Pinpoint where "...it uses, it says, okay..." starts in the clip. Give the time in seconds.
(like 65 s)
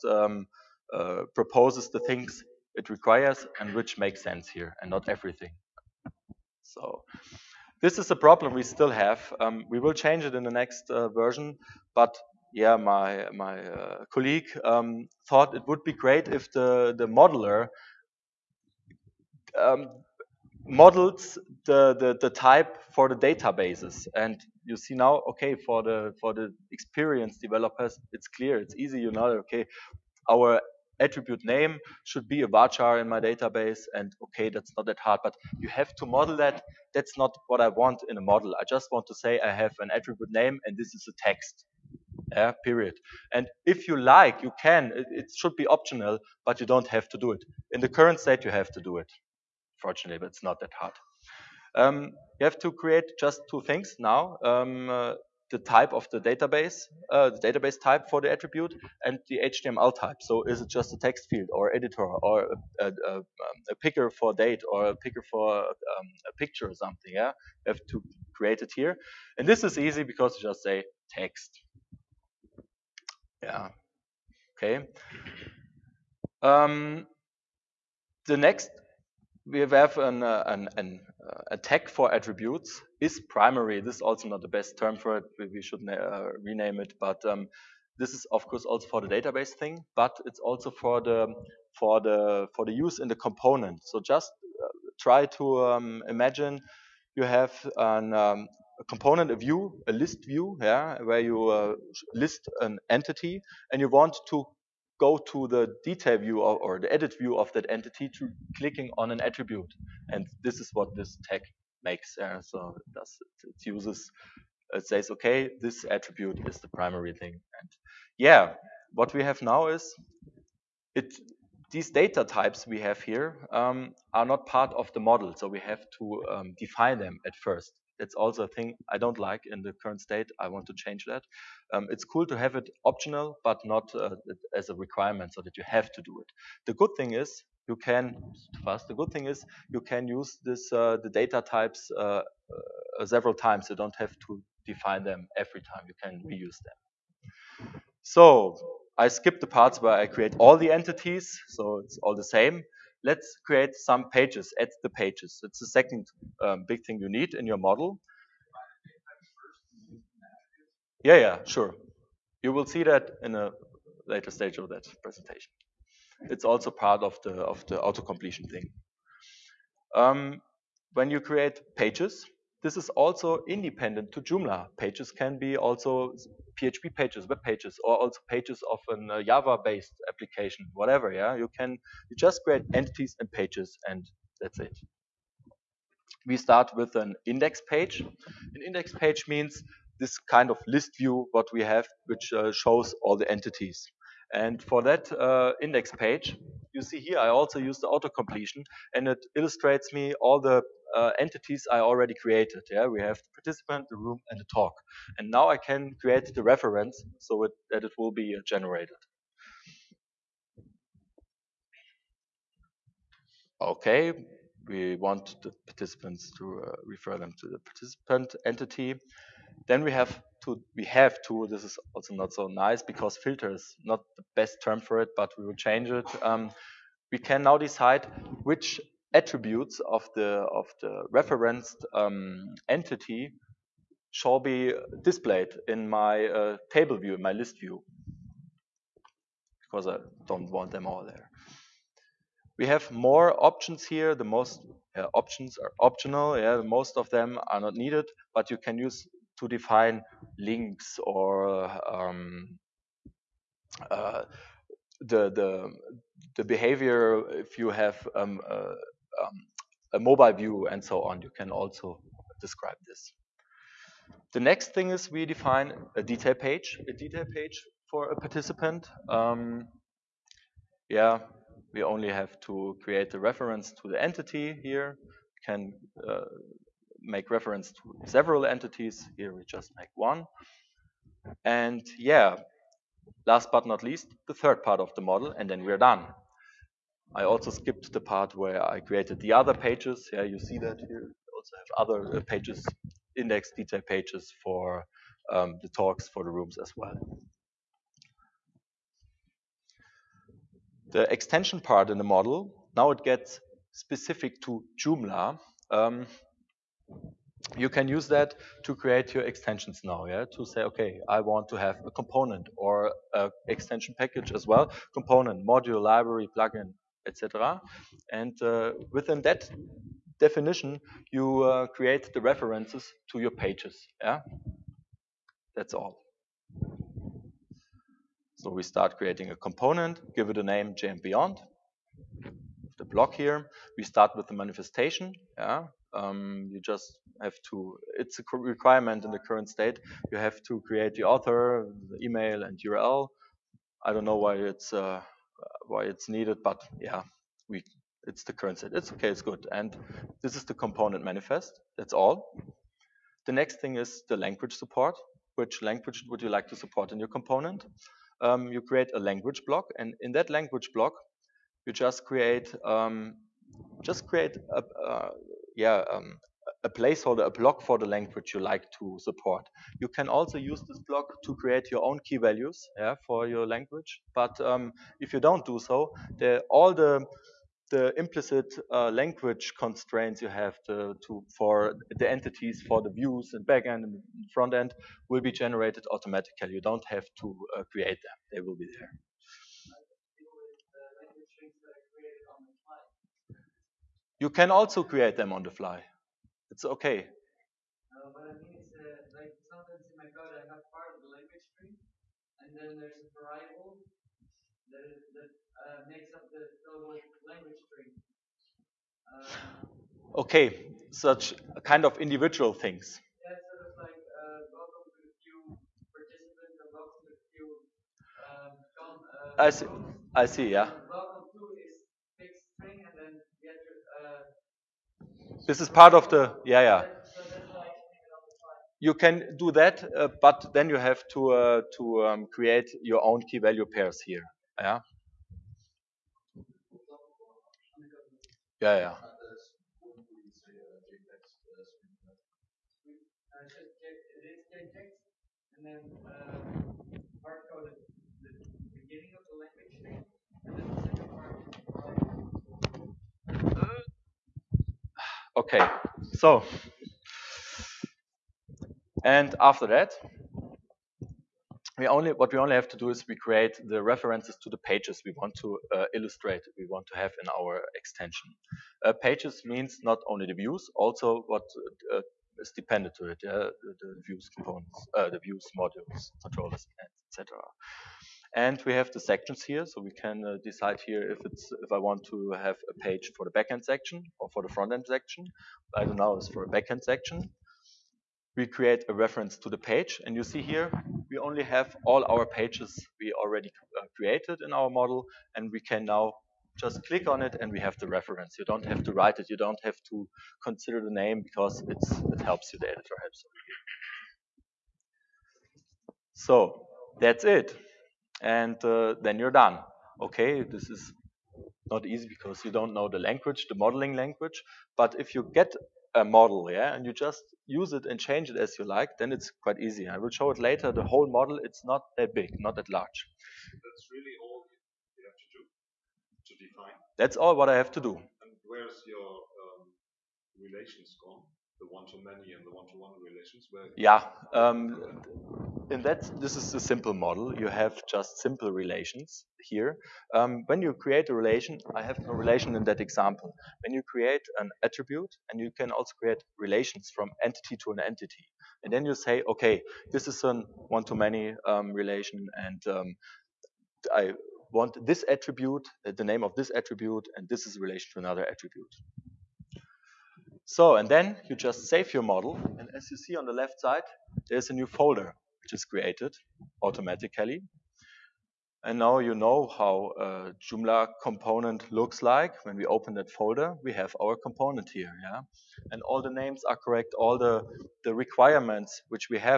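113 s.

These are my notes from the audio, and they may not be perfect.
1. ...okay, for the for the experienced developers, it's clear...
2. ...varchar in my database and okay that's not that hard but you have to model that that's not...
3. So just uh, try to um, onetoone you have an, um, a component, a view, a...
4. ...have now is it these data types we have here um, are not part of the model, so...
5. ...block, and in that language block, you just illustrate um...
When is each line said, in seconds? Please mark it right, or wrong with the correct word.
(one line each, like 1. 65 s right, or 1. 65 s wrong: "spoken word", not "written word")
1. 25 s right
2. 32 s right
3. 93 s wrong: "imagine", not "onetoone"
4. 119 s right
5. 359 s wrong: "create", not "illustrate".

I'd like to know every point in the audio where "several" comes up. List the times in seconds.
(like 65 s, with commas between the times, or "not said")
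143 s, 278 s.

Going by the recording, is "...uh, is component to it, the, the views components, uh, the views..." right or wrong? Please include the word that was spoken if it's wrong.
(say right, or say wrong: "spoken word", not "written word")
wrong: "dependent", not "component".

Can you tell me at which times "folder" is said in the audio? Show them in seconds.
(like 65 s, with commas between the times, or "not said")
564 s, 573 s.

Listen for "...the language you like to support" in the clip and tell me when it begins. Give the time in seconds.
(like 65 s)
367 s.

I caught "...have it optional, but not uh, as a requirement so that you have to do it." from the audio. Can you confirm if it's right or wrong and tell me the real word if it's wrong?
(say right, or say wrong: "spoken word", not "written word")
right.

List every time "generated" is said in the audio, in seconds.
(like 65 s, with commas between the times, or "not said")
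208 s, 385 s.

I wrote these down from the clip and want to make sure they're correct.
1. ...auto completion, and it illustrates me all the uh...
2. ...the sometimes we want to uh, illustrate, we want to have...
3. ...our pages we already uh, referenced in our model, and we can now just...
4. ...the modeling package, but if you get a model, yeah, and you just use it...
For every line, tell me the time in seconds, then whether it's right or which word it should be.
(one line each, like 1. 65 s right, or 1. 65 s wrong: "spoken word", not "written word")
1. 197 s right
2. 464 s wrong: "pages", not "sometimes"
3. 492 s wrong: "created", not "referenced"
4. 513 s wrong: "language", not "package".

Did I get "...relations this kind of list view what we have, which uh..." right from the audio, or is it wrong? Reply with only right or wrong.
wrong.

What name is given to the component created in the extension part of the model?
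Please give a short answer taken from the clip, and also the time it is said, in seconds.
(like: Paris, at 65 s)
J and Beyond, at 330 s.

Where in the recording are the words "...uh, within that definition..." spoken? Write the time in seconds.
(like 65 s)
318 s.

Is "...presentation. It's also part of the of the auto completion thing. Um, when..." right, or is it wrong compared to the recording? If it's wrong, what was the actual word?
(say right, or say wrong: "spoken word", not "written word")
right.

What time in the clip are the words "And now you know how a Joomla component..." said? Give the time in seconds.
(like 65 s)
568 s.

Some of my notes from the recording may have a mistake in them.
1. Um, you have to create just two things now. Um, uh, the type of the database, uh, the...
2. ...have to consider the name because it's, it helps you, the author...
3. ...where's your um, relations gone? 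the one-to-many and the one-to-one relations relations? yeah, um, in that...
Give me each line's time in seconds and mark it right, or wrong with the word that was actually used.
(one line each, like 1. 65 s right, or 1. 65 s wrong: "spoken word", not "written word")
1. 51 s right
2. 499 s wrong: "editor", not "author"
3. 528 s right.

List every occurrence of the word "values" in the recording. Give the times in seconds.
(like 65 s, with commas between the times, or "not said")
372 s, 433 s.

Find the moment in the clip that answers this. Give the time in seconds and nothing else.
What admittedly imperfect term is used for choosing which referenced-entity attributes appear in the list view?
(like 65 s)
223 s.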